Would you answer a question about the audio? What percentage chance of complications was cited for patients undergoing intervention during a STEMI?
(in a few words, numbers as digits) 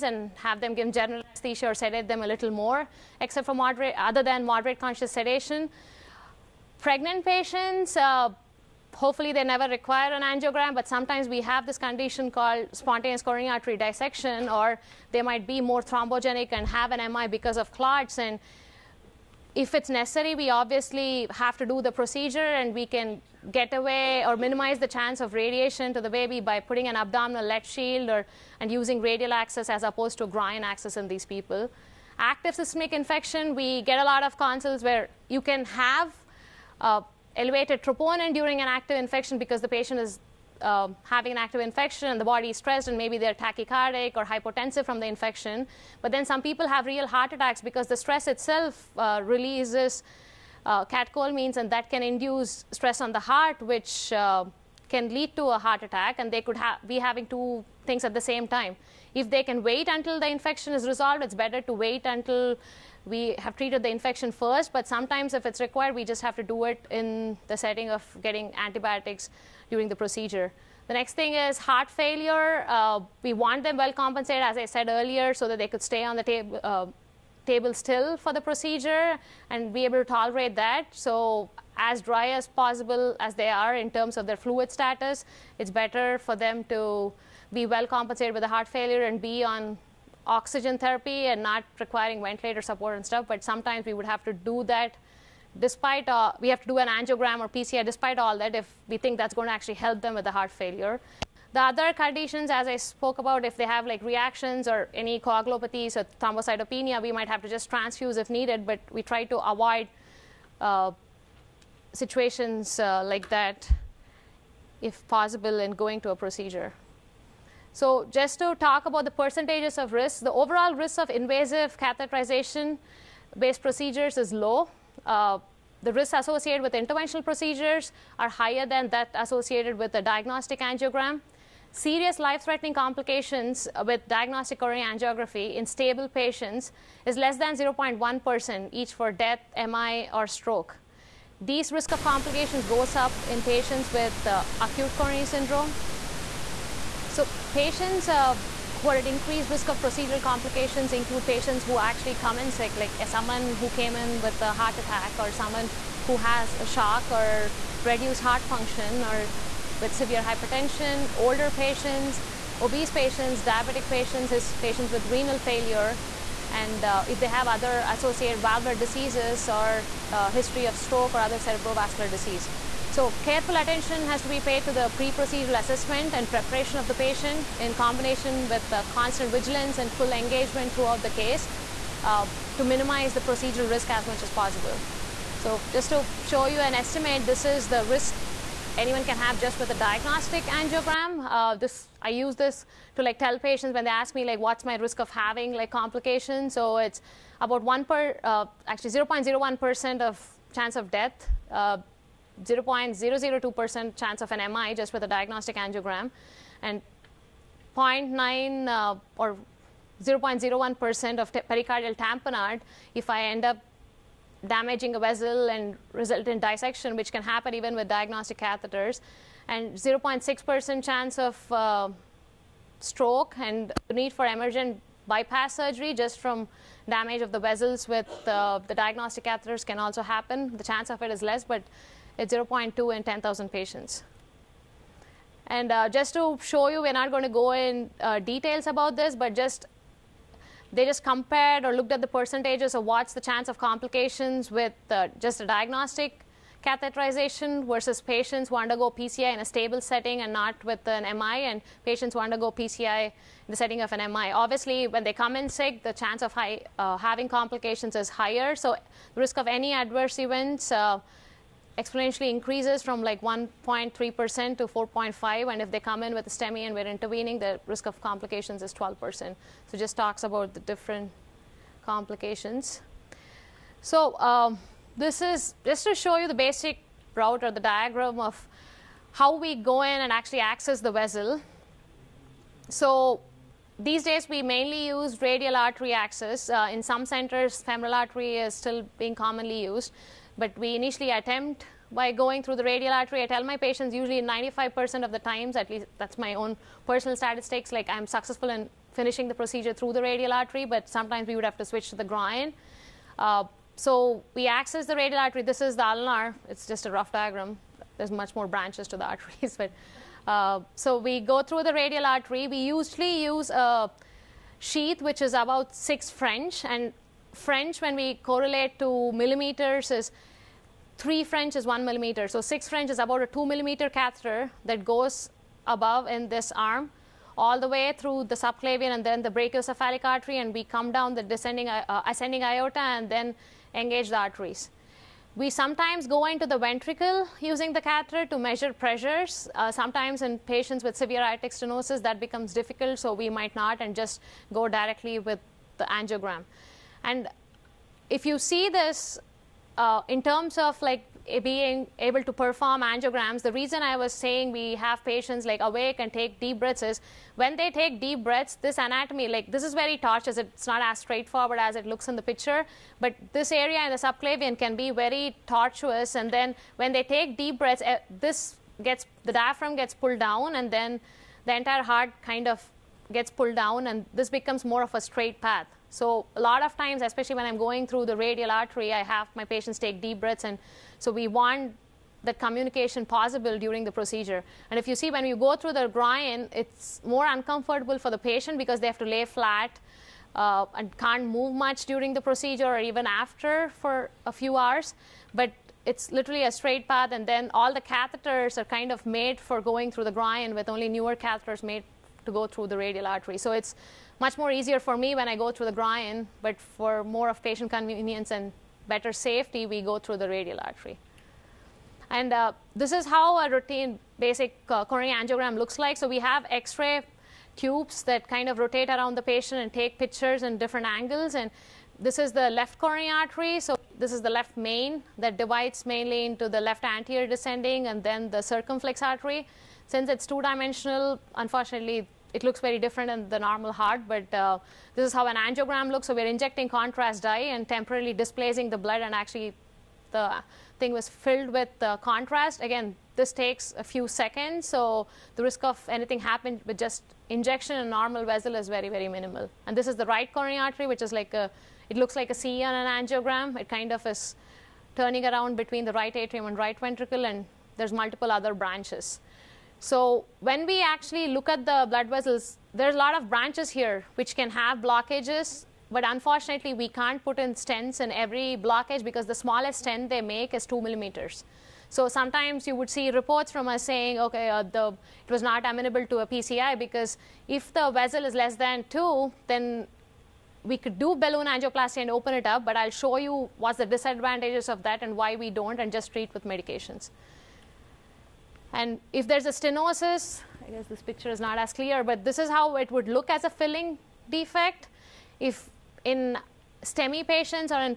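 12%.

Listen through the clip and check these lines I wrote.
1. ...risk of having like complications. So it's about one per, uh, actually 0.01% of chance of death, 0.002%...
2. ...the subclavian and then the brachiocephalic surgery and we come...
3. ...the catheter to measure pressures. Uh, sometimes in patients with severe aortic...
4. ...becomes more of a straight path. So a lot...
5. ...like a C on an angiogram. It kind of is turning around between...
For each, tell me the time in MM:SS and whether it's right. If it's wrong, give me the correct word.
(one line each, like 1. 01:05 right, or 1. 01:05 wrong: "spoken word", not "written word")
1. 03:14 right
2. 05:28 wrong: "artery", not "surgery"
3. 05:37 right
4. 06:14 right
5. 07:32 right.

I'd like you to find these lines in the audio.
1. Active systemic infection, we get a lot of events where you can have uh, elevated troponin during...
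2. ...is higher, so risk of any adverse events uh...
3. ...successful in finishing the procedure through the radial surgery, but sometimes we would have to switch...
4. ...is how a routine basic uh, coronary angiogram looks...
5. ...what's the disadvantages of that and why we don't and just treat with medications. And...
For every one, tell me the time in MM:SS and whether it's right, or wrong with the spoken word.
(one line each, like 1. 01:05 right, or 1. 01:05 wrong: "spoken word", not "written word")
1. 00:32 wrong: "consults", not "events"
2. 04:17 right
3. 04:58 wrong: "artery", not "surgery"
4. 06:52 right
5. 08:03 right.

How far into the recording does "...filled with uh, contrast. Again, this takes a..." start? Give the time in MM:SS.
07:21.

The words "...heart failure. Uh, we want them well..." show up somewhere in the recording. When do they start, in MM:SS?
01:11.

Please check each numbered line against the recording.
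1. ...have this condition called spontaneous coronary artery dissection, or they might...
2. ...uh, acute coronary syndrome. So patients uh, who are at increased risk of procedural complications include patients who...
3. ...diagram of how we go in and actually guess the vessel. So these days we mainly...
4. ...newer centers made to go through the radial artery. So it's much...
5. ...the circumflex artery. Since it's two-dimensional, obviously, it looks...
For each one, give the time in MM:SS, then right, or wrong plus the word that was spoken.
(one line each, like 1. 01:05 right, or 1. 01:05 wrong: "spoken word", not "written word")
1. 00:11 right
2. 02:24 right
3. 04:37 wrong: "access", not "guess"
4. 06:40 wrong: "catheters", not "centers"
5. 07:08 wrong: "unfortunately", not "obviously".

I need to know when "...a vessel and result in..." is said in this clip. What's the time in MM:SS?
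03:34.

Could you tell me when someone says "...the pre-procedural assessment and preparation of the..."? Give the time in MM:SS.
02:54.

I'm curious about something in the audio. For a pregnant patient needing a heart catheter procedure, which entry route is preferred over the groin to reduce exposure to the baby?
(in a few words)
Radial access.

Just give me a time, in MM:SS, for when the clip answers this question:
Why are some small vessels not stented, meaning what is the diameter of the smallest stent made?
07:50.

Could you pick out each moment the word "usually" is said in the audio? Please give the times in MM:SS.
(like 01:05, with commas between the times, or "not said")
04:53, 05:12.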